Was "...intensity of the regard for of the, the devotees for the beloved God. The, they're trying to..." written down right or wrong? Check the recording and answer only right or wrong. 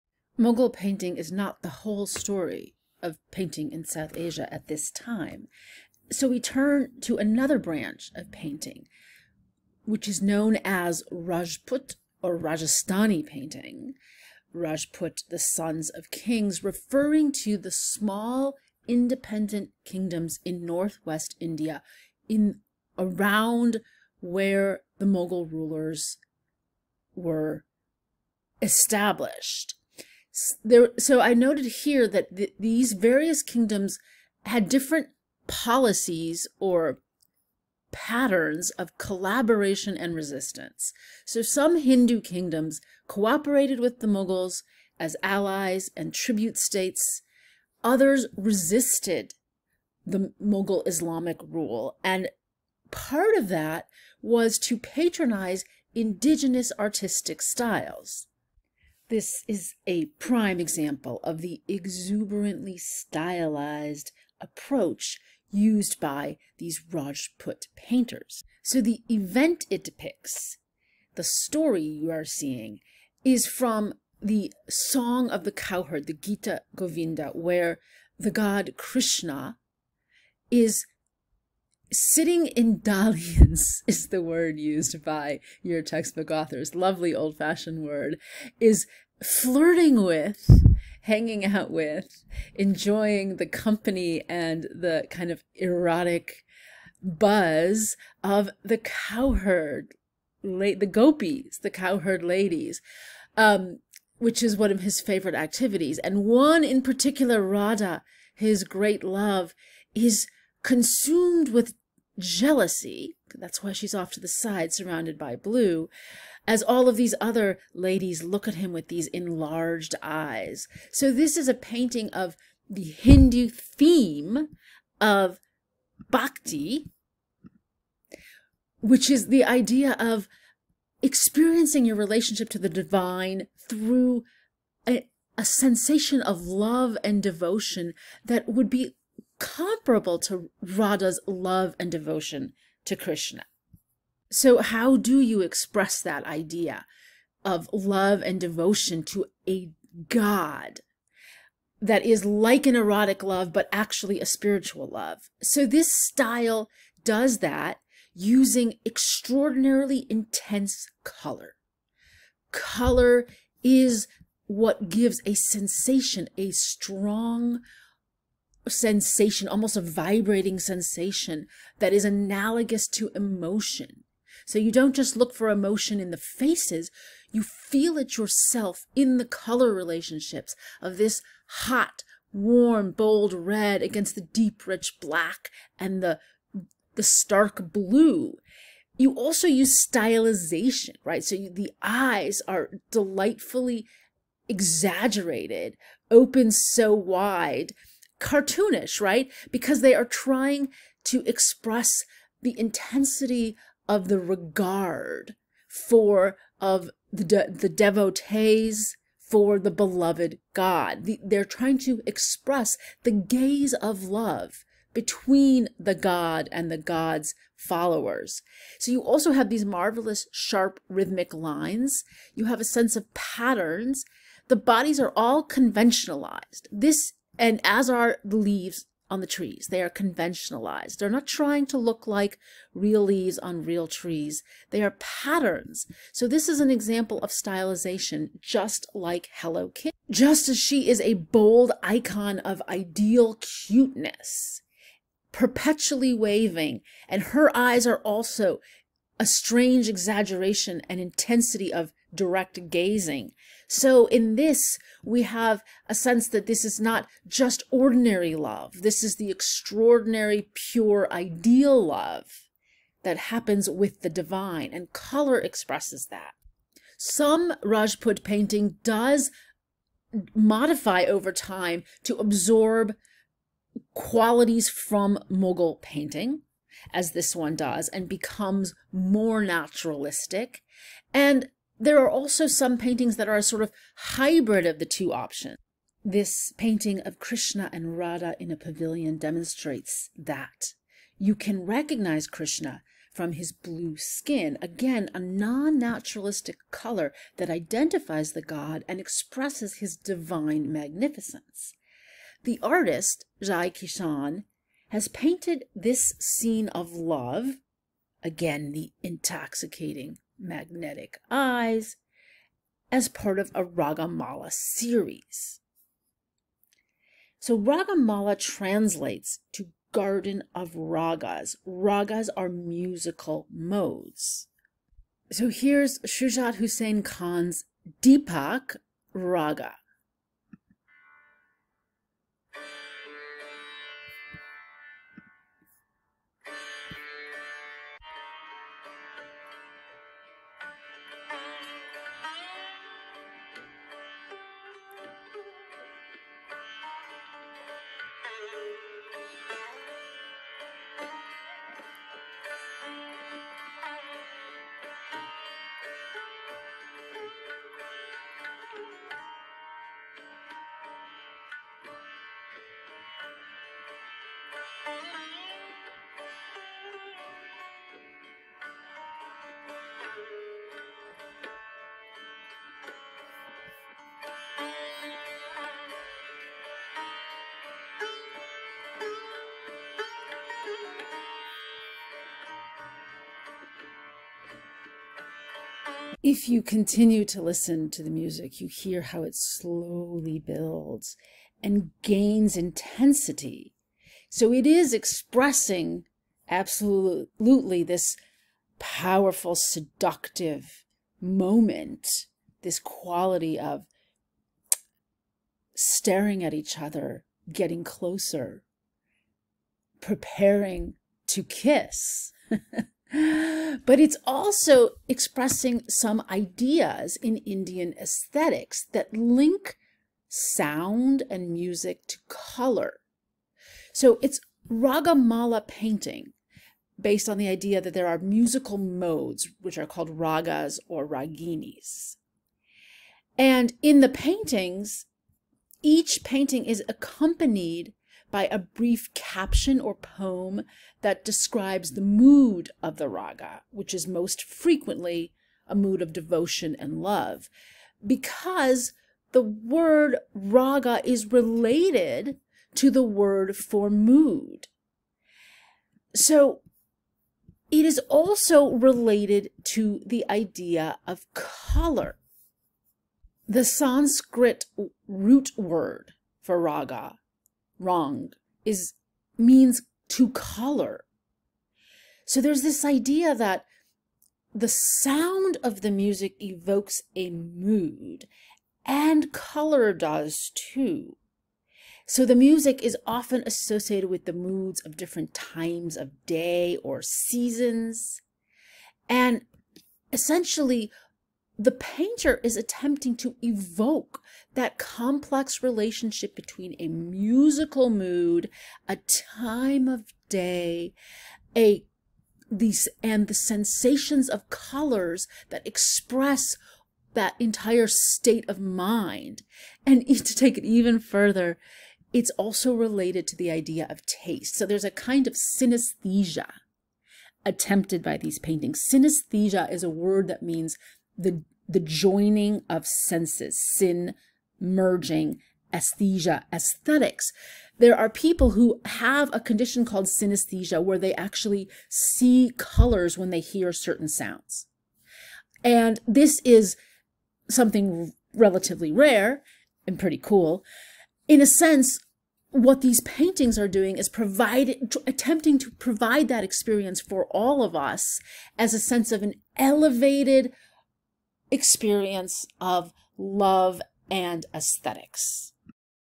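right.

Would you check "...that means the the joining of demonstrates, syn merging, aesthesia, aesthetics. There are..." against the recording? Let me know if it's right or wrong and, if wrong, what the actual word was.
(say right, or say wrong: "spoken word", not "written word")
wrong: "senses", not "demonstrates".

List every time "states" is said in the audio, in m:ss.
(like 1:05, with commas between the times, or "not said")
0:46, 8:27.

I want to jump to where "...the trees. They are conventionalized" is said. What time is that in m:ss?
3:49.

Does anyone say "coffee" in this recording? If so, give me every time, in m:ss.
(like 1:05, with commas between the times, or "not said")
not said.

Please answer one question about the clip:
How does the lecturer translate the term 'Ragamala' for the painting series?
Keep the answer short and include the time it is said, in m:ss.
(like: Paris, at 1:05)
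garden of ragas, at 5:19.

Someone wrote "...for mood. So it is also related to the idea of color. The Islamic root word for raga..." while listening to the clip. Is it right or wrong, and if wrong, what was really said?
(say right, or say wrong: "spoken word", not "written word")
wrong: "Sanskrit", not "Islamic".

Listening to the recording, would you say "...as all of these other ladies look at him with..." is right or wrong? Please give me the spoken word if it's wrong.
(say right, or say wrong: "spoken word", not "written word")
right.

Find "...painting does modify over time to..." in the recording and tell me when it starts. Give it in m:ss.
4:28.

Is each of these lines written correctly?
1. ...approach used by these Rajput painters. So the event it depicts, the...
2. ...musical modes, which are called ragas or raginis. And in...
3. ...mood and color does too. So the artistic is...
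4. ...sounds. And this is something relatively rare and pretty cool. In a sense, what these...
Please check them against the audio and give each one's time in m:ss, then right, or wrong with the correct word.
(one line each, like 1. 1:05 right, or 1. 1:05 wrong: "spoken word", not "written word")
1. 1:04 right
2. 7:08 right
3. 7:57 wrong: "music", not "artistic"
4. 8:54 right.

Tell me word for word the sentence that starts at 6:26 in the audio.
if you continue to listen to the music, you hear how it slowly builds and gains intensity.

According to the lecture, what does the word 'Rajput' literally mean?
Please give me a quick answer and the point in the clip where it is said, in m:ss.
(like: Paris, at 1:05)
the sons of kings, at 0:15.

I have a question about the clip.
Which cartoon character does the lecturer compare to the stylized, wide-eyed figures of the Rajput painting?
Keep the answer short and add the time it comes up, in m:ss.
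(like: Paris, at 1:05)
Hello Kitty, at 3:59.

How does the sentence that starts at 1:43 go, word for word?
Um, which is one of his favorite activities.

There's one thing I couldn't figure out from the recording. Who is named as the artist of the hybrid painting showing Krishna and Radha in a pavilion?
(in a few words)
Jai Kishan.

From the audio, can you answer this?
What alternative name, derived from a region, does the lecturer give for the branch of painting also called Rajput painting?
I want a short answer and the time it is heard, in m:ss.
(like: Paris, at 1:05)
Rajasthani painting, at 0:12.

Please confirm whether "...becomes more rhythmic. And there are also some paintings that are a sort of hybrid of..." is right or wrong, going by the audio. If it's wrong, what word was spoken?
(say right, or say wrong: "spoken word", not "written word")
wrong: "naturalistic", not "rhythmic".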